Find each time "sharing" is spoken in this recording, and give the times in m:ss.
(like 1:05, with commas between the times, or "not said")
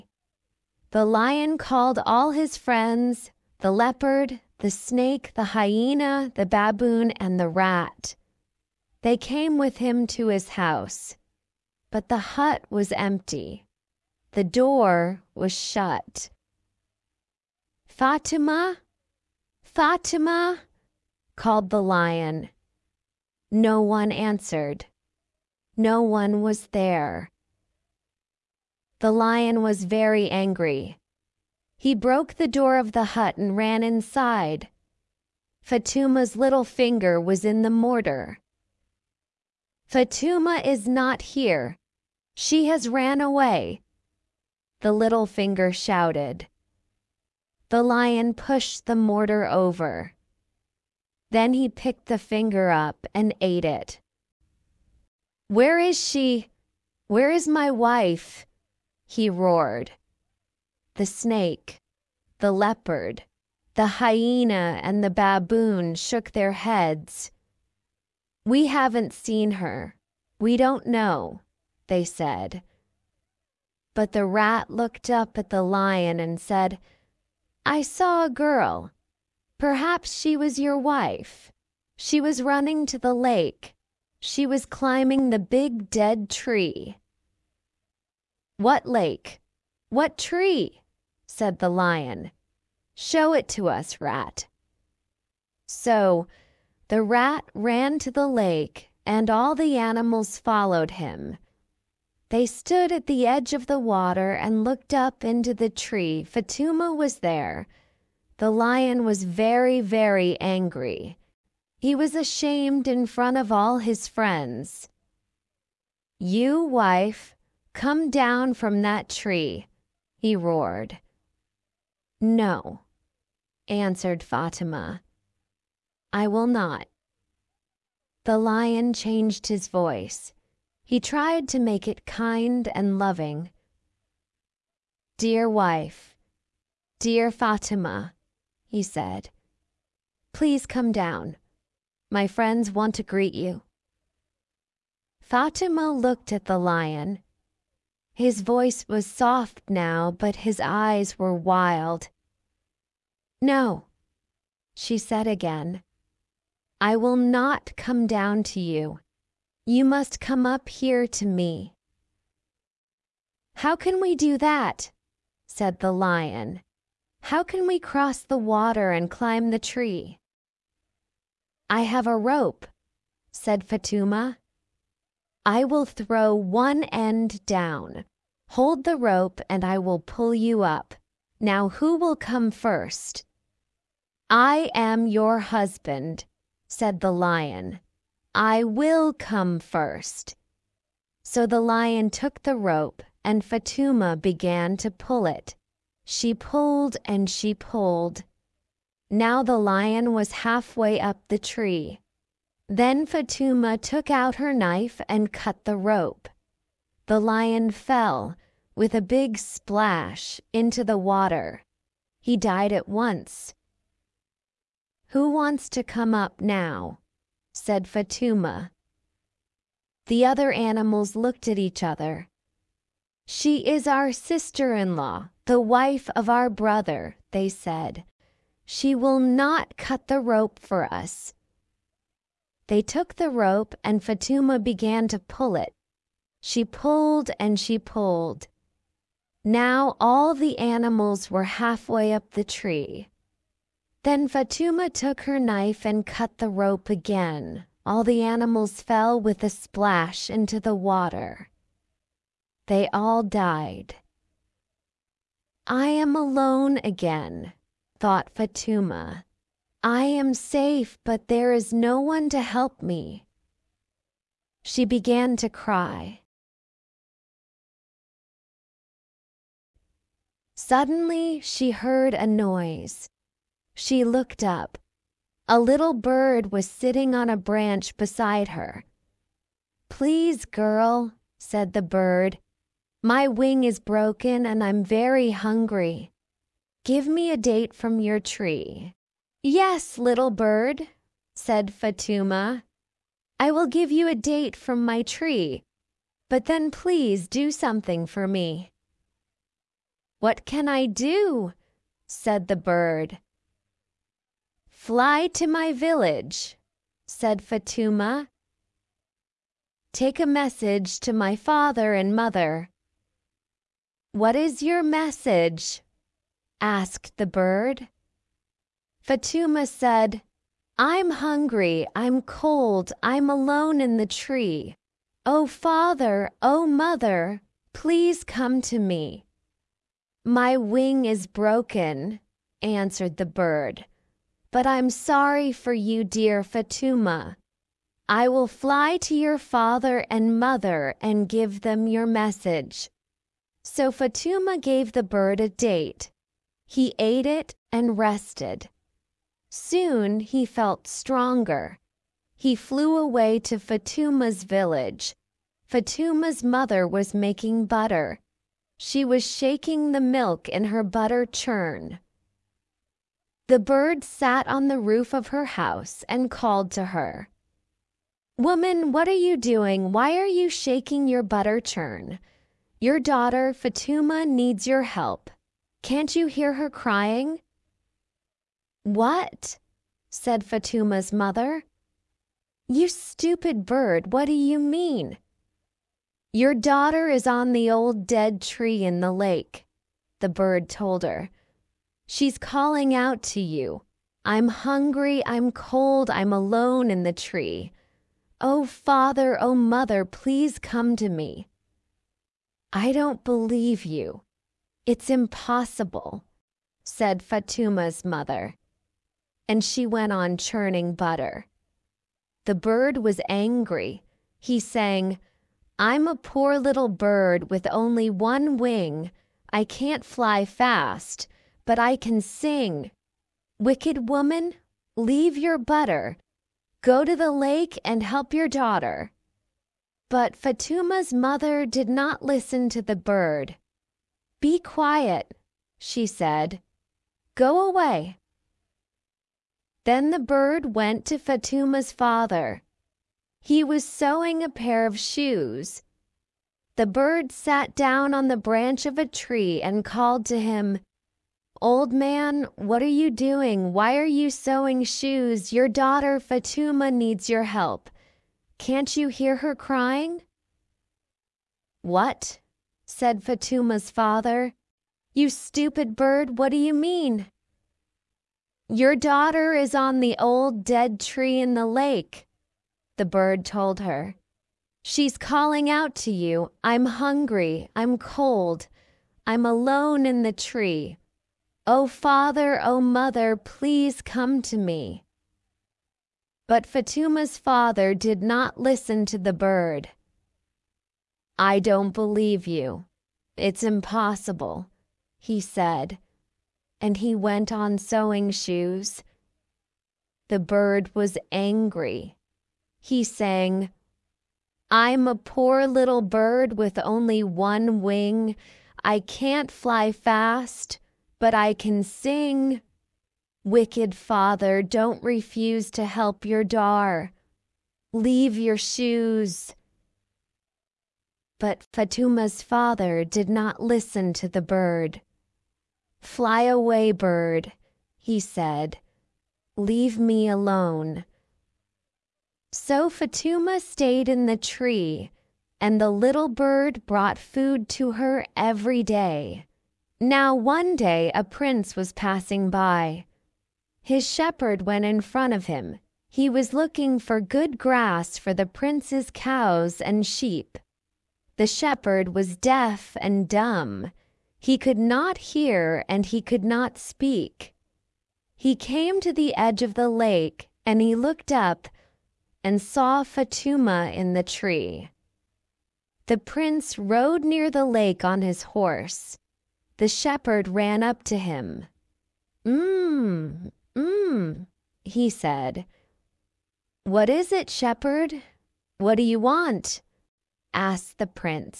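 not said.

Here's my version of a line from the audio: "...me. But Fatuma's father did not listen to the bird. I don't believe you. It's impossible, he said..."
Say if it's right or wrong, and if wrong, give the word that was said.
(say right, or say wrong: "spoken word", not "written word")
right.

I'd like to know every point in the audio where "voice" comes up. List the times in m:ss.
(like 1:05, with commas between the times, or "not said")
2:09, 2:28.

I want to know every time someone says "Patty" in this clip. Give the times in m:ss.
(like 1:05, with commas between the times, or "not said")
not said.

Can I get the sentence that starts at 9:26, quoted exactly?
The prince rode near the lake on his horse.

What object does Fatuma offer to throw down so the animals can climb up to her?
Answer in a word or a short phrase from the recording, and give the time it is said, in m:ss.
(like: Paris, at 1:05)
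A rope, at 2:52.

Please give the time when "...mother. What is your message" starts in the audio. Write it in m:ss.
5:12.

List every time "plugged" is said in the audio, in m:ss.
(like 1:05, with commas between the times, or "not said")
not said.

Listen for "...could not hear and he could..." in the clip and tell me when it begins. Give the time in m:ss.
9:14.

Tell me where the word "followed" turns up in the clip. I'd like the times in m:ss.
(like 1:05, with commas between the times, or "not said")
1:40.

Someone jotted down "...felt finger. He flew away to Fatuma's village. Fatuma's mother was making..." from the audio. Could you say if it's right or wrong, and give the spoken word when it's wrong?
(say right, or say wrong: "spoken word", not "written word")
wrong: "stronger", not "finger".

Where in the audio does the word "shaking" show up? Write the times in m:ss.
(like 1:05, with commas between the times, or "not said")
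5:59, 6:10.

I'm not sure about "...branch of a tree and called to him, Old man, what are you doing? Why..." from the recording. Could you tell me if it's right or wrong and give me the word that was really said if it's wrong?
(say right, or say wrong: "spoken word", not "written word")
right.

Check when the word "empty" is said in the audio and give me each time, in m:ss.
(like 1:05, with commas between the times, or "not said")
0:12.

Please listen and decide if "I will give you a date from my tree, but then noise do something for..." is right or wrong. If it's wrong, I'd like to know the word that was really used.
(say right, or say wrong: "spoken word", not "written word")
wrong: "please", not "noise".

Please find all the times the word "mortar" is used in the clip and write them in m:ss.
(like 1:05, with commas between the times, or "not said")
0:37, 0:48.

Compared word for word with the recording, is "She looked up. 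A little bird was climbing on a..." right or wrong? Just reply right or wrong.
wrong.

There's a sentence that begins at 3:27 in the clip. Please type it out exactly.
The lion fell, with a big splash, into the water.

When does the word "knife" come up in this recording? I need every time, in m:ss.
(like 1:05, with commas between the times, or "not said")
3:24, 4:05.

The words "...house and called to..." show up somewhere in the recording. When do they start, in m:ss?
6:05.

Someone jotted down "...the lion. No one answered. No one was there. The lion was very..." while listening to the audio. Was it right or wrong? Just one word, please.
right.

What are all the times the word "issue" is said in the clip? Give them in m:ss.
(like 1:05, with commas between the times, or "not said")
not said.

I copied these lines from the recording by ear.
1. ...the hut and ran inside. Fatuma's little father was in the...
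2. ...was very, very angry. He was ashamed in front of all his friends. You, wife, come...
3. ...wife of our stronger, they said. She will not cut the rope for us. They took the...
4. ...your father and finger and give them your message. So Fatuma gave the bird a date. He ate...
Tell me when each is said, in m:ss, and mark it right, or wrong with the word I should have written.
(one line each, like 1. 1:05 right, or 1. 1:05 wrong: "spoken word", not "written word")
1. 0:32 wrong: "finger", not "father"
2. 1:49 right
3. 3:45 wrong: "brother", not "stronger"
4. 5:39 wrong: "mother", not "finger".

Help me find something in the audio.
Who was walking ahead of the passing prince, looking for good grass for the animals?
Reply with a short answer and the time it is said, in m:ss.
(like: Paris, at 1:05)
His shepherd, at 9:03.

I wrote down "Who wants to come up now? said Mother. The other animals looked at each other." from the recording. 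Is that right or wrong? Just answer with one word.
wrong.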